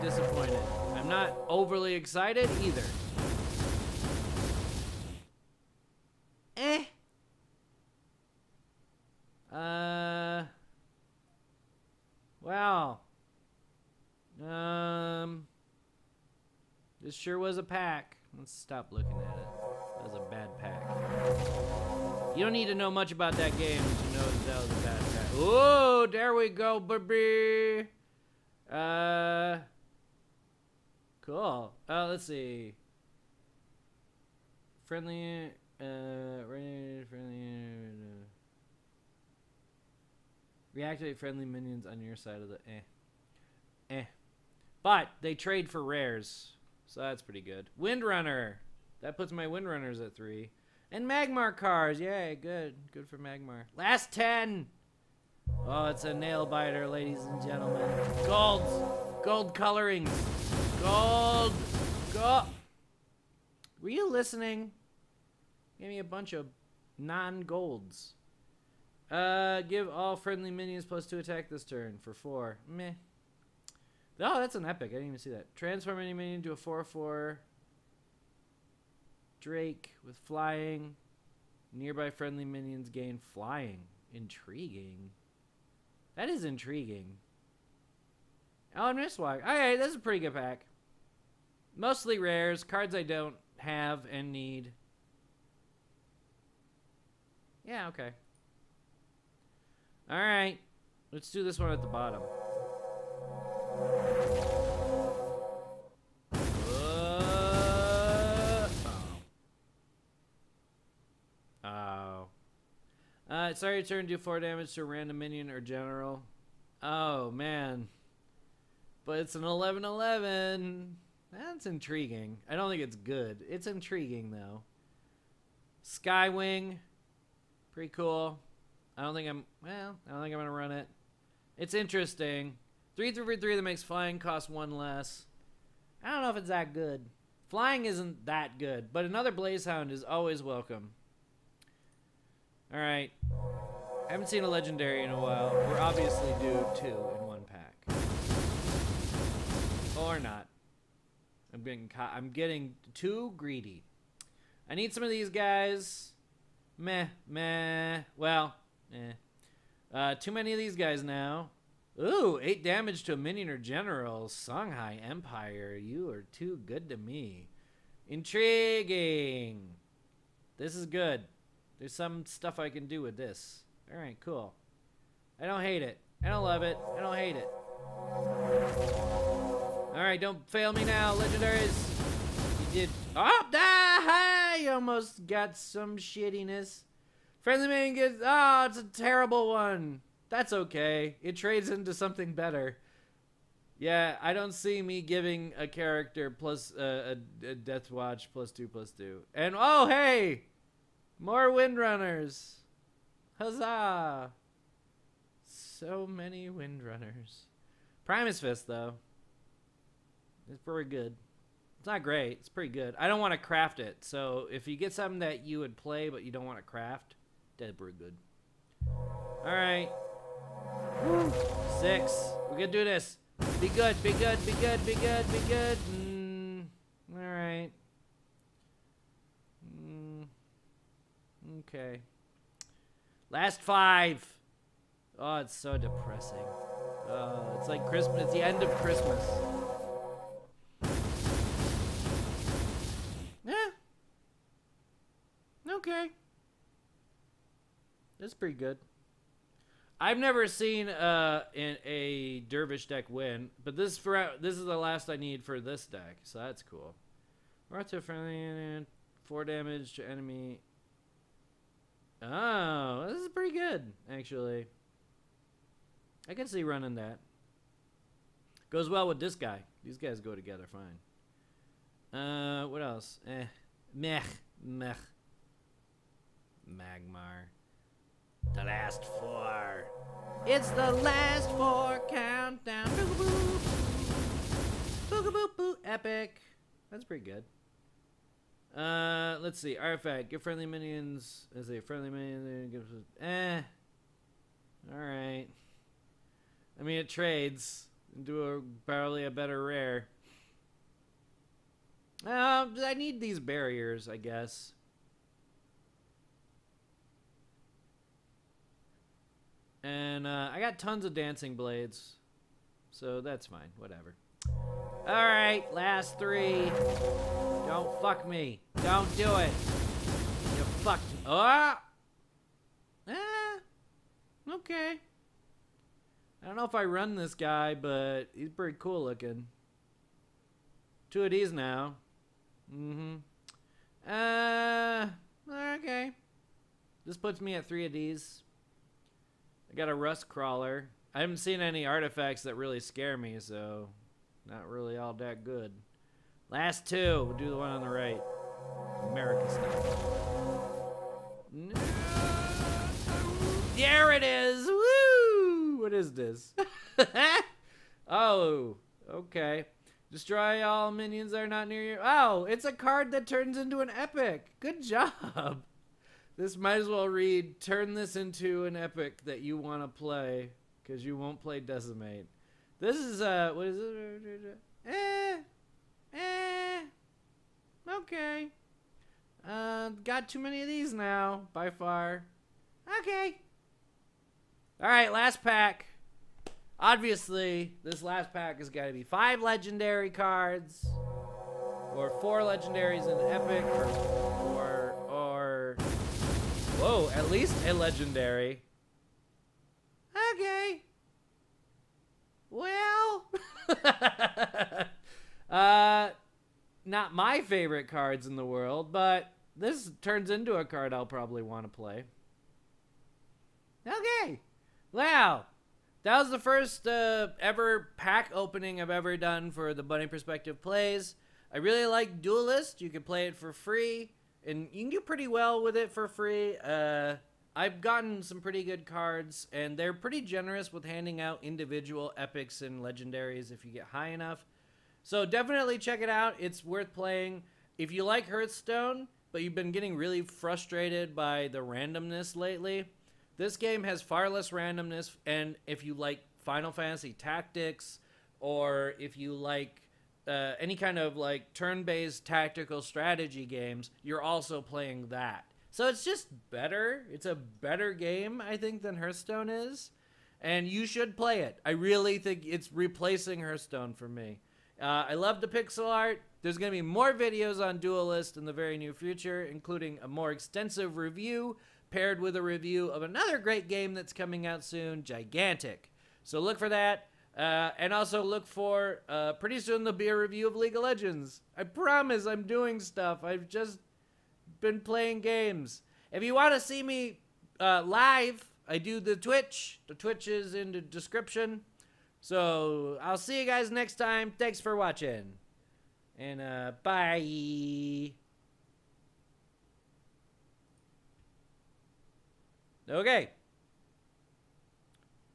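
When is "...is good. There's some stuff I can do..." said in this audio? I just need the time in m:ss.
2:50.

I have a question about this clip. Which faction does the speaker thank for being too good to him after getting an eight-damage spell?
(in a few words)
Songhai Empire.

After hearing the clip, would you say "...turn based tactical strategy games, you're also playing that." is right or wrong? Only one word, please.
right.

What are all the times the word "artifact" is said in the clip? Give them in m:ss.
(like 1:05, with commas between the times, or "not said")
4:49, 5:41.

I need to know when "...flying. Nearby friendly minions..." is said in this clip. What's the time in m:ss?
1:20.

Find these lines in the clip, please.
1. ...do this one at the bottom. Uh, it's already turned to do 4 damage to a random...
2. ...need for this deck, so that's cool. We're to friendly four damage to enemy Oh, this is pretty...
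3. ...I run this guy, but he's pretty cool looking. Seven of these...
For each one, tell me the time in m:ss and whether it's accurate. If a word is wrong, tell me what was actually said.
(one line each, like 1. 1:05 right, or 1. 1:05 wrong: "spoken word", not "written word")
1. 1:41 right
2. 4:15 right
3. 5:26 wrong: "Two", not "Seven".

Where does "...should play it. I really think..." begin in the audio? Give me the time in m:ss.
7:40.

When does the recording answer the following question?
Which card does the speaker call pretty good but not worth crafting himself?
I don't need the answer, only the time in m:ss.
3:28.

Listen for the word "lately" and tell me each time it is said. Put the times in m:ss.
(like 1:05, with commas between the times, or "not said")
7:22.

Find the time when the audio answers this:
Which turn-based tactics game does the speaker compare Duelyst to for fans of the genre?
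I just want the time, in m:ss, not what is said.
7:26.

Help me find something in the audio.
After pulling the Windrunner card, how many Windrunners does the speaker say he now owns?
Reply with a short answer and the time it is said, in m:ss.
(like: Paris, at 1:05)
3, at 0:49.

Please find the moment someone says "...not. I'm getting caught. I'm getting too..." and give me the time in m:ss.
2:30.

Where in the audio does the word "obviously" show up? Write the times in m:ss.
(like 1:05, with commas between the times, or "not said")
2:25, 6:26.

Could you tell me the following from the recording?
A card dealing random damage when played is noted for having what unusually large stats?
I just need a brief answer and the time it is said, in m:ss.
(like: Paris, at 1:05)
11-11, at 1:59.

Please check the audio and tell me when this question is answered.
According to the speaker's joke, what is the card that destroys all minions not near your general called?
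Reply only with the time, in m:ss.
6:11.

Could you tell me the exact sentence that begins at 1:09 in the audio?
Uh, give all friendly minions plus two attack this turn for four.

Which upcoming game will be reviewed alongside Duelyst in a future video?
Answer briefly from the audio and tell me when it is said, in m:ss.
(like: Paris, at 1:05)
Gigantic, at 7:55.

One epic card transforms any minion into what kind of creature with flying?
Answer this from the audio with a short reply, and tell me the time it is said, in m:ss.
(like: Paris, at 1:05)
4-4 Drake, at 1:16.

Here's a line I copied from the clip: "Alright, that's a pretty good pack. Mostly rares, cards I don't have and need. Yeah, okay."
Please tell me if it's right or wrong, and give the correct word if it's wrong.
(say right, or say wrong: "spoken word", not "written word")
right.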